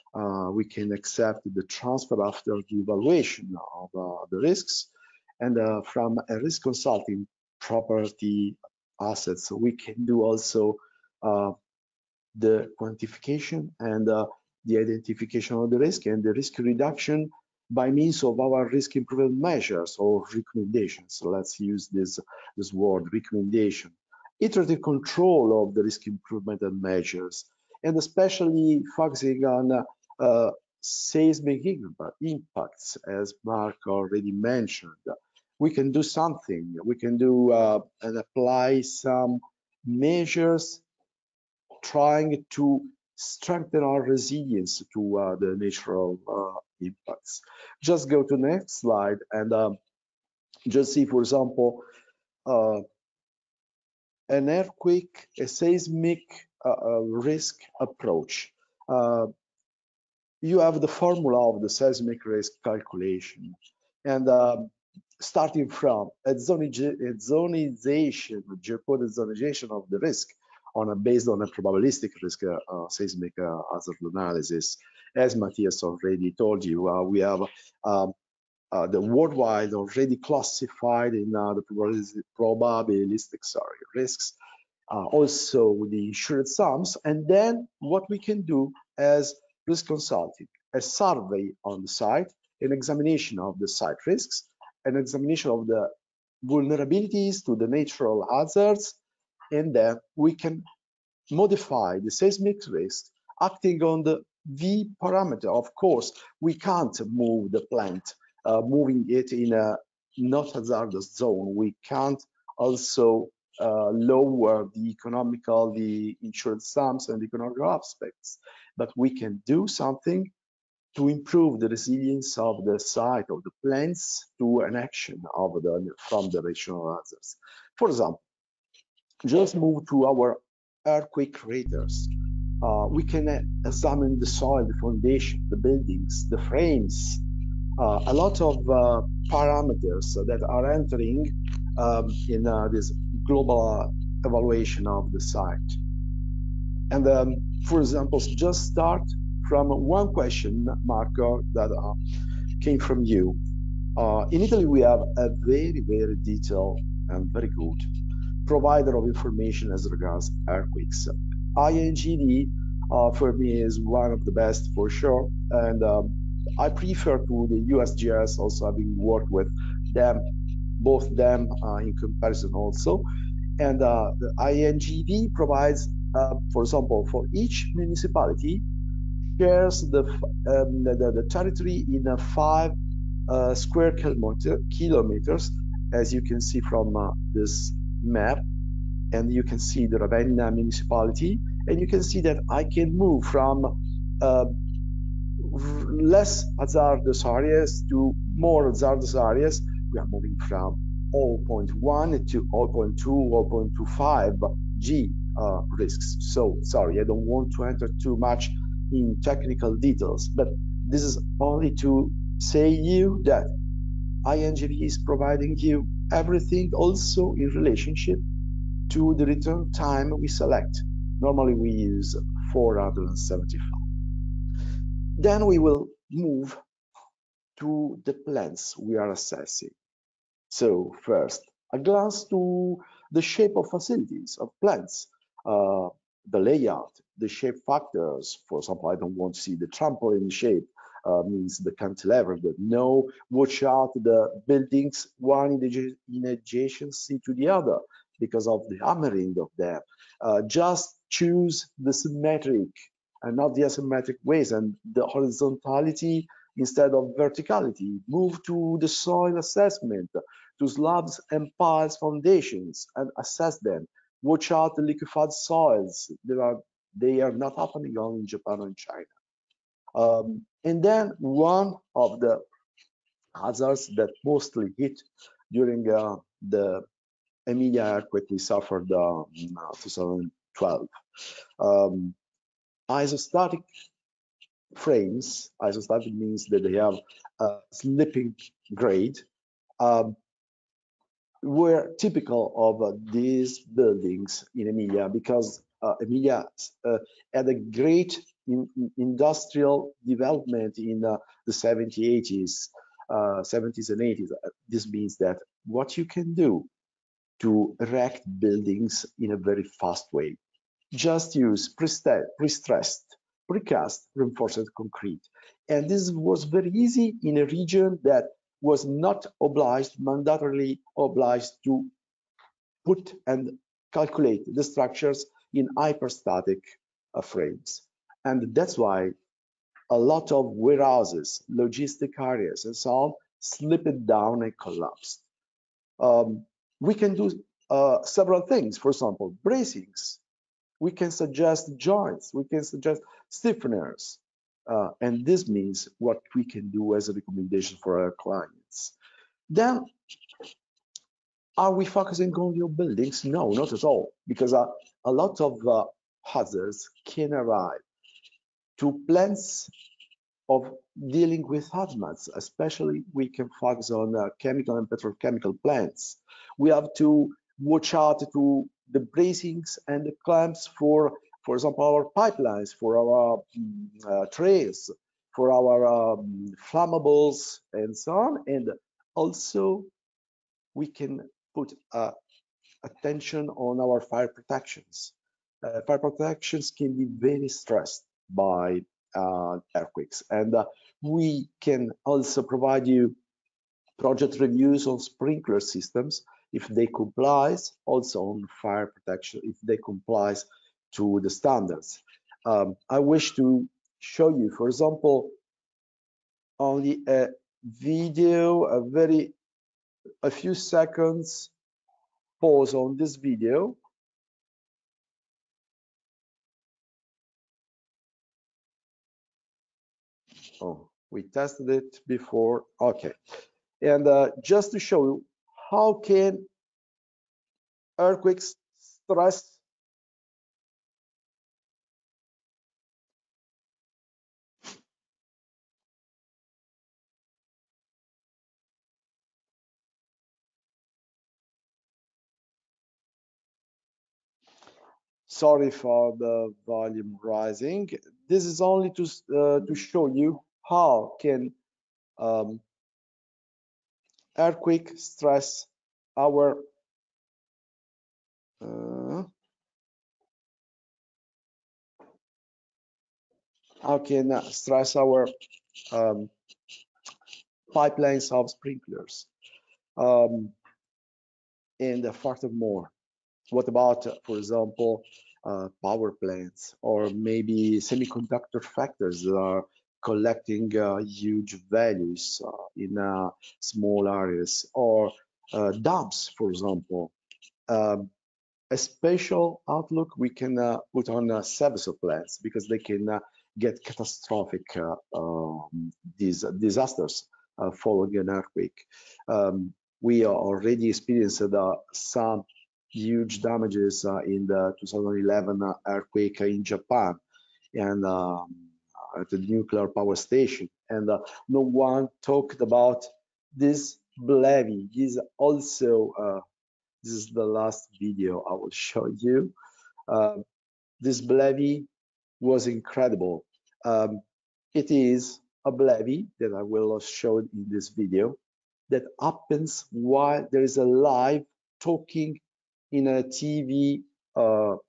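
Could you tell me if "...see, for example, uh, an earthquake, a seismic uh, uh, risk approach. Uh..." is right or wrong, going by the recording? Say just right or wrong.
right.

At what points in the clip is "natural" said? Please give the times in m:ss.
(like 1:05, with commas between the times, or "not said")
0:45, 1:37.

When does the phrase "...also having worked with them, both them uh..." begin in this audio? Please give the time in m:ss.
2:48.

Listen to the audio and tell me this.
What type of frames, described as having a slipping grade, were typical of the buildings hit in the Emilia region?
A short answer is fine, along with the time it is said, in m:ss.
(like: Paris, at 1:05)
Isostatic frames, at 4:42.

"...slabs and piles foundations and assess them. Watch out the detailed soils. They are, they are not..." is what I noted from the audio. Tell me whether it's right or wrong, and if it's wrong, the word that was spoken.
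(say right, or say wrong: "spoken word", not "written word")
wrong: "liquefied", not "detailed".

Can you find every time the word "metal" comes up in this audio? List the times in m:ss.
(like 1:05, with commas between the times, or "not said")
not said.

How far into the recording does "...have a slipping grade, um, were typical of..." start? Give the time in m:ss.
4:46.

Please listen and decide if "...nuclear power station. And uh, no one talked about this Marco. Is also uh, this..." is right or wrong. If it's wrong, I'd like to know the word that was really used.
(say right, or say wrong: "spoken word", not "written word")
wrong: "BLEVE", not "Marco".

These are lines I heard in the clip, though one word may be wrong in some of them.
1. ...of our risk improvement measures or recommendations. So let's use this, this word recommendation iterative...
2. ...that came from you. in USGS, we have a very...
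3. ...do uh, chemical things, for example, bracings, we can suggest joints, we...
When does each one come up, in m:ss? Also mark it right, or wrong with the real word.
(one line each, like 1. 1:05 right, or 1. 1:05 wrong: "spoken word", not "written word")
1. 0:18 right
2. 2:31 wrong: "Italy", not "USGS"
3. 5:37 wrong: "several", not "chemical".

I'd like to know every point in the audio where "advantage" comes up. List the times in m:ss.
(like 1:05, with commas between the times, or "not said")
not said.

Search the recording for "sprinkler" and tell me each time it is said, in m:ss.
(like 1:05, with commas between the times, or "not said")
6:34, 7:48.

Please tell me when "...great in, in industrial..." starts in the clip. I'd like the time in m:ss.
4:57.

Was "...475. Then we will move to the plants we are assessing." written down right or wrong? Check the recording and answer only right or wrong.
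right.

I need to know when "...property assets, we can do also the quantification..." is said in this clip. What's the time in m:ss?
0:07.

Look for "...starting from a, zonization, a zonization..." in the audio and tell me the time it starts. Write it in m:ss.
1:05.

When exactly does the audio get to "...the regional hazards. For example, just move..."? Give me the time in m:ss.
2:06.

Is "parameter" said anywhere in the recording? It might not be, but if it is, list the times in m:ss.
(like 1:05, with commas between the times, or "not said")
1:45, 2:19.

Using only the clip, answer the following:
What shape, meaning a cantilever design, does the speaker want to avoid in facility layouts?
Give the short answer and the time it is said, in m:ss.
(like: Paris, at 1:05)
trampoline shape, at 3:59.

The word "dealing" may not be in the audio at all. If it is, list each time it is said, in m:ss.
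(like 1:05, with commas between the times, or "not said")
6:01.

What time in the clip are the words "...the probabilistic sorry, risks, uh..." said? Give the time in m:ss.
1:21.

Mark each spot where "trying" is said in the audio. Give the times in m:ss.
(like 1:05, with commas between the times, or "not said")
0:41.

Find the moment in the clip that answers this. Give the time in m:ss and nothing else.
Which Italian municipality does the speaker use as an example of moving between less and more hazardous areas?
3:09.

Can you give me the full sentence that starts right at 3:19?
We are moving from 0.1 to 0.2, 0.25 G uh, risks.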